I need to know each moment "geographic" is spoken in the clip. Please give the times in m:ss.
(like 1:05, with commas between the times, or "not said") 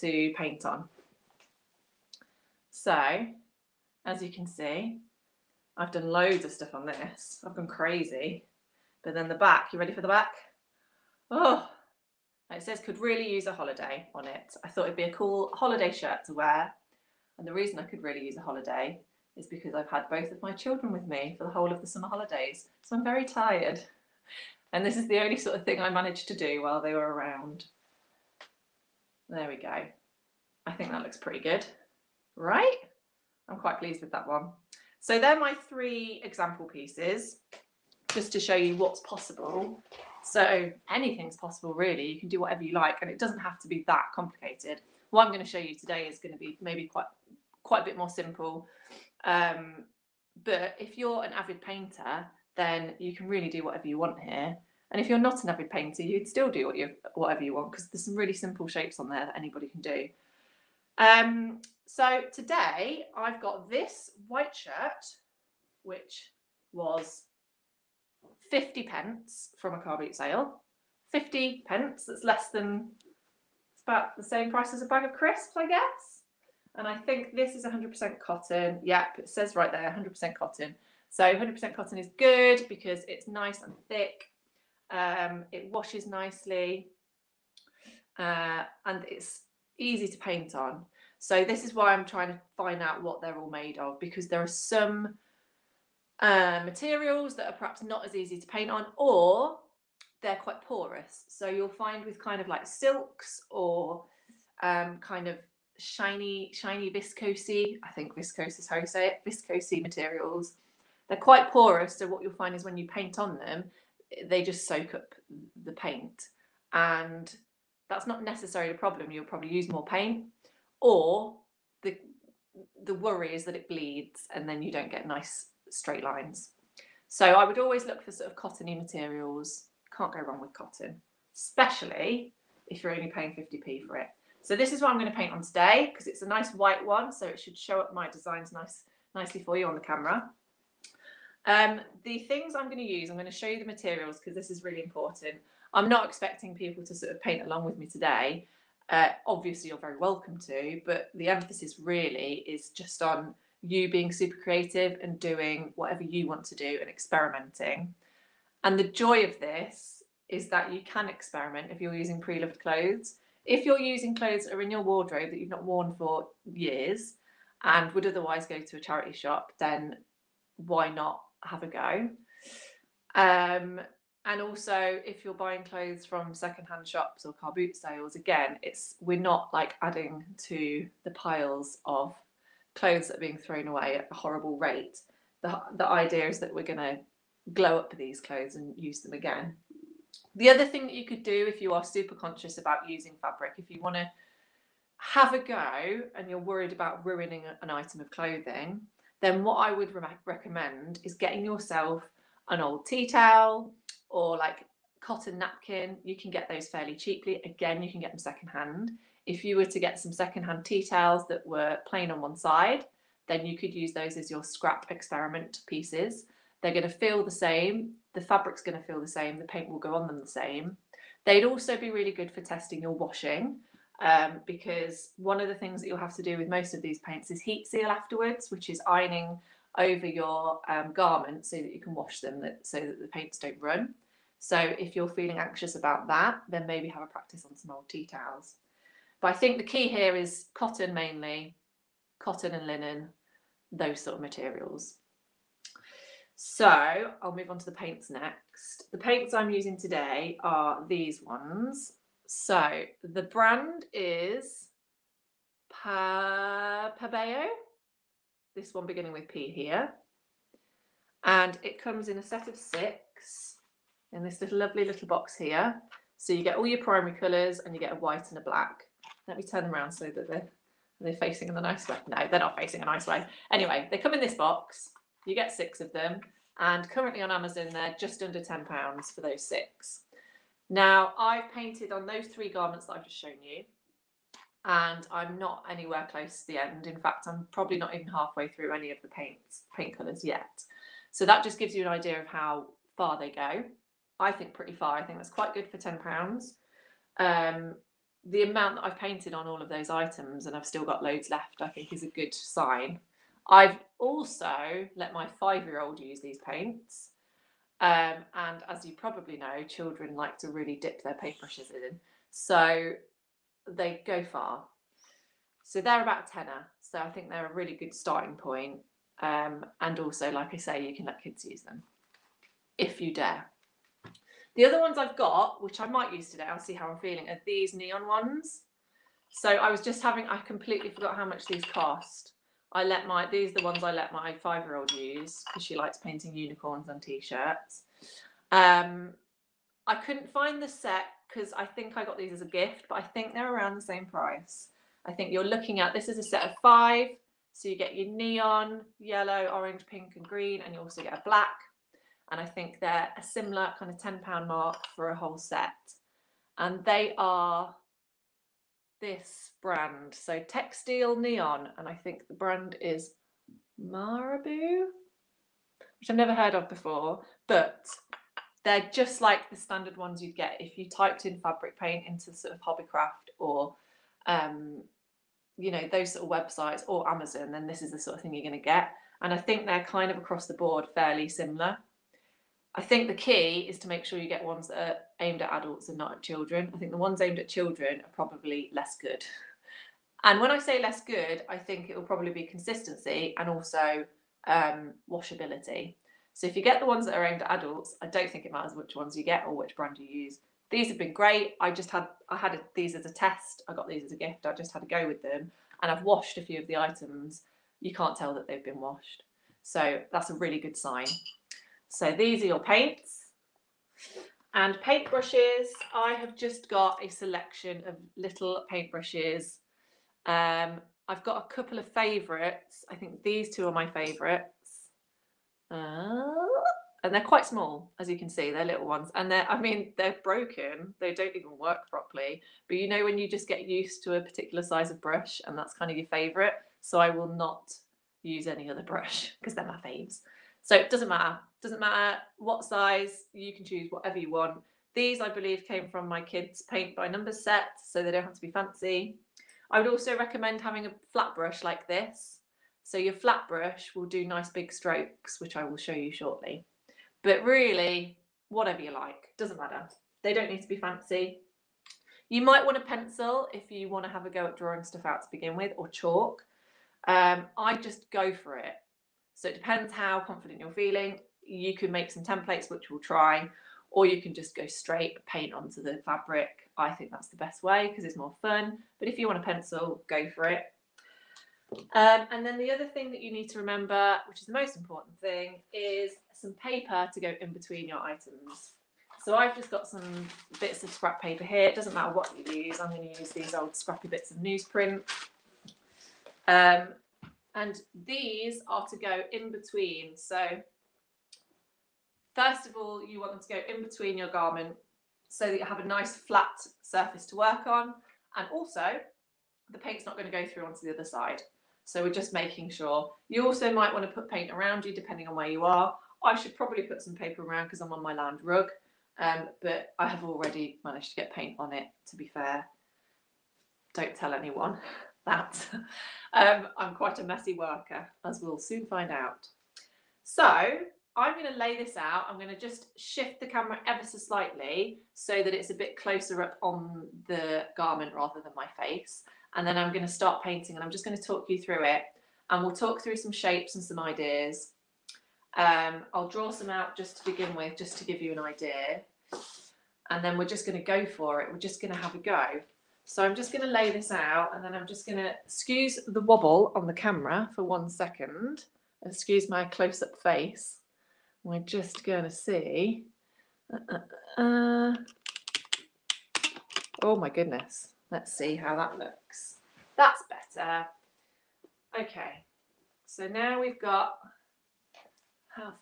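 not said.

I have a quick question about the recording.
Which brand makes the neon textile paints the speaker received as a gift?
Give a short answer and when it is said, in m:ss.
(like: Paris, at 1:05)
Marabu, at 6:03.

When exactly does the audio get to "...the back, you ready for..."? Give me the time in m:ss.
0:09.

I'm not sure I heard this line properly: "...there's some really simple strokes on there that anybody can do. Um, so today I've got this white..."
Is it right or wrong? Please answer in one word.
wrong.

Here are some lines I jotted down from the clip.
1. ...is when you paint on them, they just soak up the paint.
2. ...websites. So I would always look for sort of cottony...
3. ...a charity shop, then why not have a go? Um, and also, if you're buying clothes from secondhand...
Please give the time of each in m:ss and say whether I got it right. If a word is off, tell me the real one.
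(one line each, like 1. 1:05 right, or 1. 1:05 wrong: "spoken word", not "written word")
1. 1:52 right
2. 2:06 wrong: "lines", not "websites"
3. 2:48 right.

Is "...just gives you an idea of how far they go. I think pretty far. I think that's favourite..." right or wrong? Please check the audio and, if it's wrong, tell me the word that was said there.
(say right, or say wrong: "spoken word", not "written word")
wrong: "quite", not "favourite".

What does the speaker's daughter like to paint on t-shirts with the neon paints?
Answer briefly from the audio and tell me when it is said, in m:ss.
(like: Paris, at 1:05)
Unicorns, at 5:36.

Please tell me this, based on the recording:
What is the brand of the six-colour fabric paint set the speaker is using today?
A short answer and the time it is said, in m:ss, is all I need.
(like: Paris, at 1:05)
Pabeo, at 4:16.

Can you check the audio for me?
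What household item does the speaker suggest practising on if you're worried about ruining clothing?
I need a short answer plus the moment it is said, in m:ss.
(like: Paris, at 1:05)
Tea towel, at 3:22.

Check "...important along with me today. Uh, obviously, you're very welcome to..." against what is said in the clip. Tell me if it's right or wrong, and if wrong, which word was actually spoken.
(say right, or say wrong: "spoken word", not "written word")
wrong: "paint", not "important".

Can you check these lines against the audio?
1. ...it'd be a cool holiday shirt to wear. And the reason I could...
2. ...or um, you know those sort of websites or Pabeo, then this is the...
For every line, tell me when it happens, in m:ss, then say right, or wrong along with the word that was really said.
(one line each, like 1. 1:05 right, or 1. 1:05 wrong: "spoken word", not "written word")
1. 0:14 right
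2. 6:13 wrong: "Amazon", not "Pabeo".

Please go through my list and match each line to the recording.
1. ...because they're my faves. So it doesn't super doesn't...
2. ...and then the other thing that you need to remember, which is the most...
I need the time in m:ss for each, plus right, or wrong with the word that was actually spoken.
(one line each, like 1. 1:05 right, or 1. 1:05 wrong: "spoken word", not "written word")
1. 7:19 wrong: "matter", not "super"
2. 8:02 right.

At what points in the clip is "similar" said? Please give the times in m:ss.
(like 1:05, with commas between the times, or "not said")
5:53, 6:21.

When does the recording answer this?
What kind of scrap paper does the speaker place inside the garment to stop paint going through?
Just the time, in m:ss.
8:14.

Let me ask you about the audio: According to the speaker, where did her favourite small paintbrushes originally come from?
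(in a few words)
Kids' paint by number set.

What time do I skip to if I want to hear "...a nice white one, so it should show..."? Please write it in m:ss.
2:16.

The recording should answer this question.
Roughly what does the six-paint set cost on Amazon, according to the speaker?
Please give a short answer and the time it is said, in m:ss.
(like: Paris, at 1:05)
Just under £10, at 4:37.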